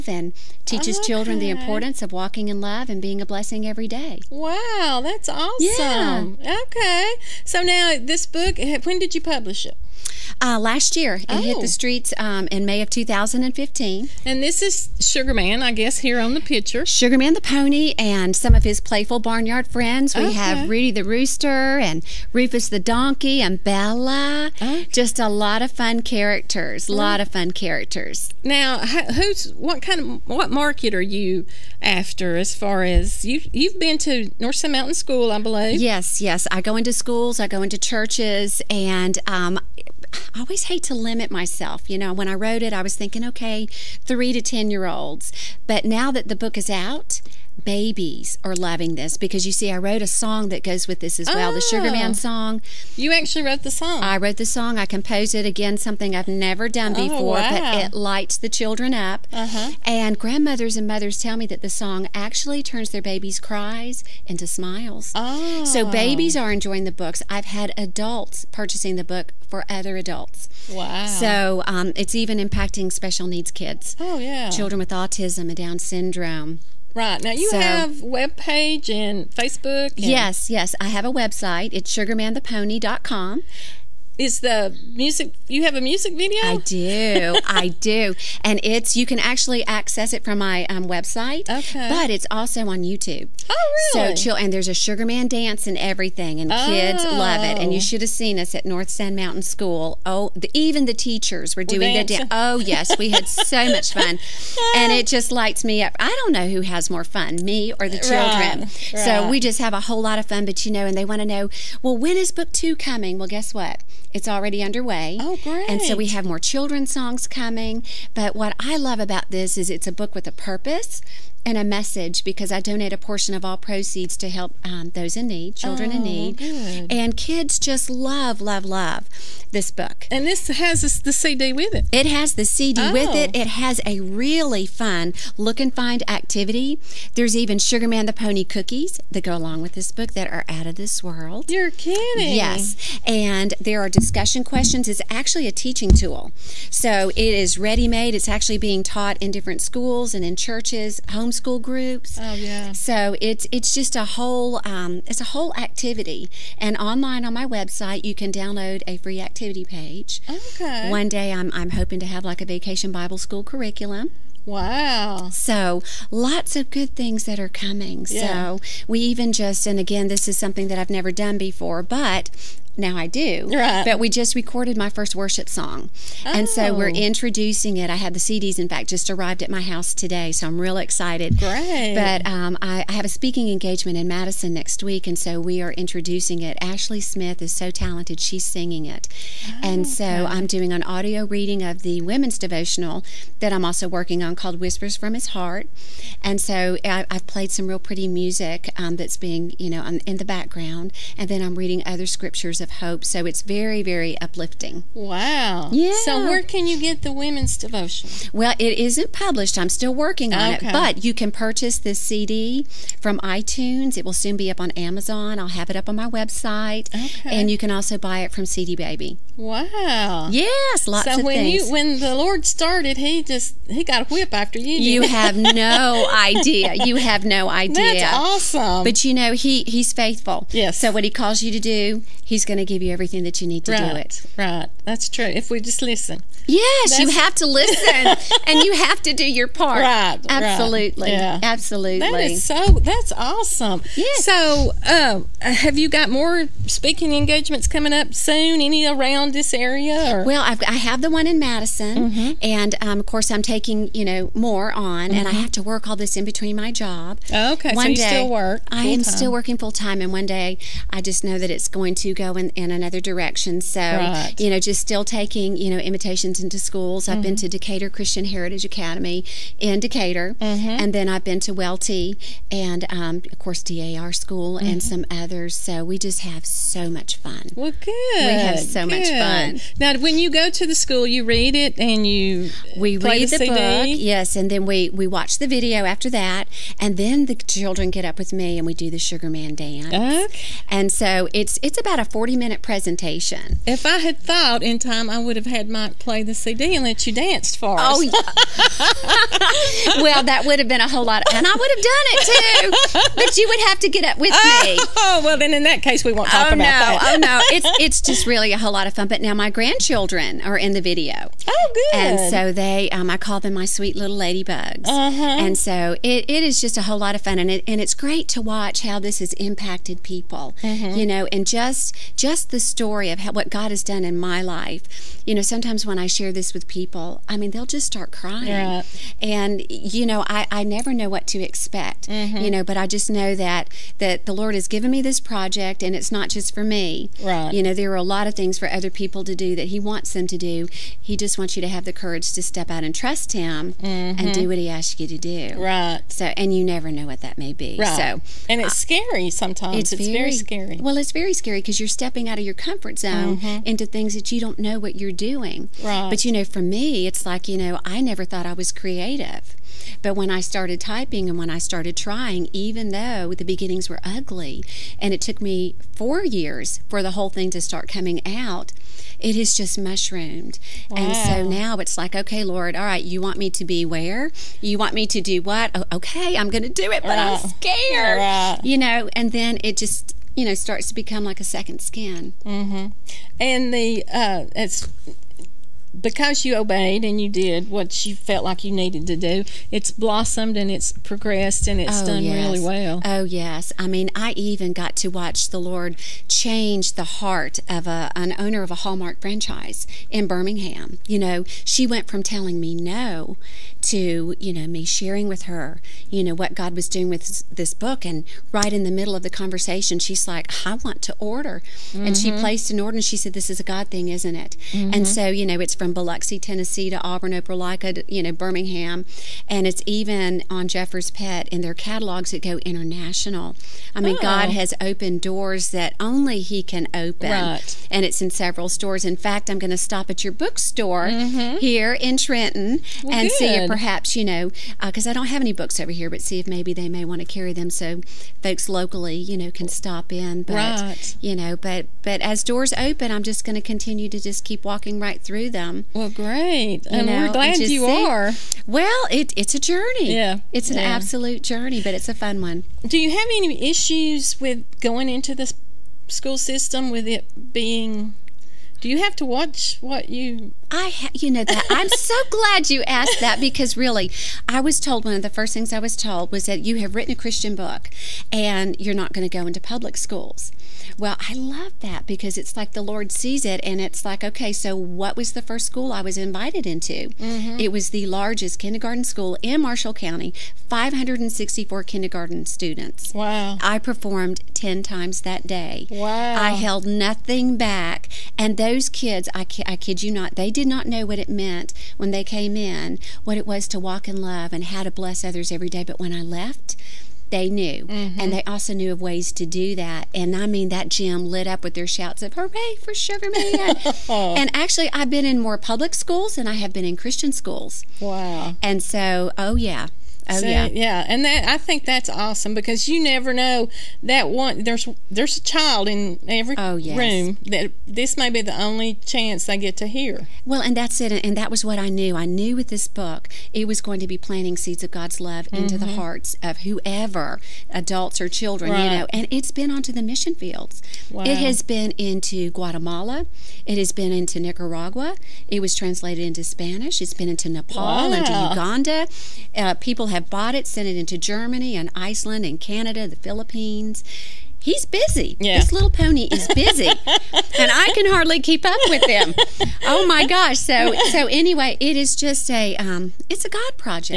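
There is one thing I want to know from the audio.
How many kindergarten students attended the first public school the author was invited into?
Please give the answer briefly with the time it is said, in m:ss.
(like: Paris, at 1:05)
564, at 8:00.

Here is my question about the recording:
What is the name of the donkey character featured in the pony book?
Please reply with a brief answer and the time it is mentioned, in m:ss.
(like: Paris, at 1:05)
Rufus, at 0:22.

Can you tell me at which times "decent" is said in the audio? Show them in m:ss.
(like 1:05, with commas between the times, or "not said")
not said.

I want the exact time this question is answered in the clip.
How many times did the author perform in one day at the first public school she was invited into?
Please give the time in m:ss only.
8:04.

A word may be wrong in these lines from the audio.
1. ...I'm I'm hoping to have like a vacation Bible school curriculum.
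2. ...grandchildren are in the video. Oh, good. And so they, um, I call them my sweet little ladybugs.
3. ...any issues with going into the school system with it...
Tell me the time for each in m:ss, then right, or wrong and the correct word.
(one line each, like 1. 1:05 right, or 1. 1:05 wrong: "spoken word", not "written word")
1. 2:41 right
2. 5:09 right
3. 7:33 right.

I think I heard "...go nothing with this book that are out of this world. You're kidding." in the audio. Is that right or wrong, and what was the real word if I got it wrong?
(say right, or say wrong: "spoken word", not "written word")
wrong: "along", not "nothing".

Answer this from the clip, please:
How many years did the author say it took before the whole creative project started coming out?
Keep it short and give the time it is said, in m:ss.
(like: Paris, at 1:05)
4 years, at 6:05.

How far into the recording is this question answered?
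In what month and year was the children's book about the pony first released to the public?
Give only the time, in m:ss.
0:12.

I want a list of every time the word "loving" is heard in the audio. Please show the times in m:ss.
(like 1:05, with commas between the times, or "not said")
0:48.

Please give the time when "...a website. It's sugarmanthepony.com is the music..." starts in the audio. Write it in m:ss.
1:21.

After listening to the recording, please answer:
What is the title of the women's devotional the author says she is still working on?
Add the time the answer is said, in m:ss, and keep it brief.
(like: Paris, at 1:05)
Whispers from His Heart, at 3:14.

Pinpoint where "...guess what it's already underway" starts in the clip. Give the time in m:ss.
1:53.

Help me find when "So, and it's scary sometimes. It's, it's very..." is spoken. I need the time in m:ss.
5:48.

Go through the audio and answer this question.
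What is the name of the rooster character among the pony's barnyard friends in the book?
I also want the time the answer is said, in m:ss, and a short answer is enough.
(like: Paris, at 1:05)
Rudy, at 0:20.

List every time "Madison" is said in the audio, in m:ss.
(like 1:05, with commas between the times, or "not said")
3:04, 4:11.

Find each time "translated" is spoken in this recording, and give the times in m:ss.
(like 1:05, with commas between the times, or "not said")
8:55.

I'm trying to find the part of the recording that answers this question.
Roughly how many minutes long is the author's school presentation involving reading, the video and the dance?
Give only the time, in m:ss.
4:52.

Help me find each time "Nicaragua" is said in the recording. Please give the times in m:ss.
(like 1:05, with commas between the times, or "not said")
8:54.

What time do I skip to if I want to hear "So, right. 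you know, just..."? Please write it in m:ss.
4:23.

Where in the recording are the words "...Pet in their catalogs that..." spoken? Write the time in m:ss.
7:01.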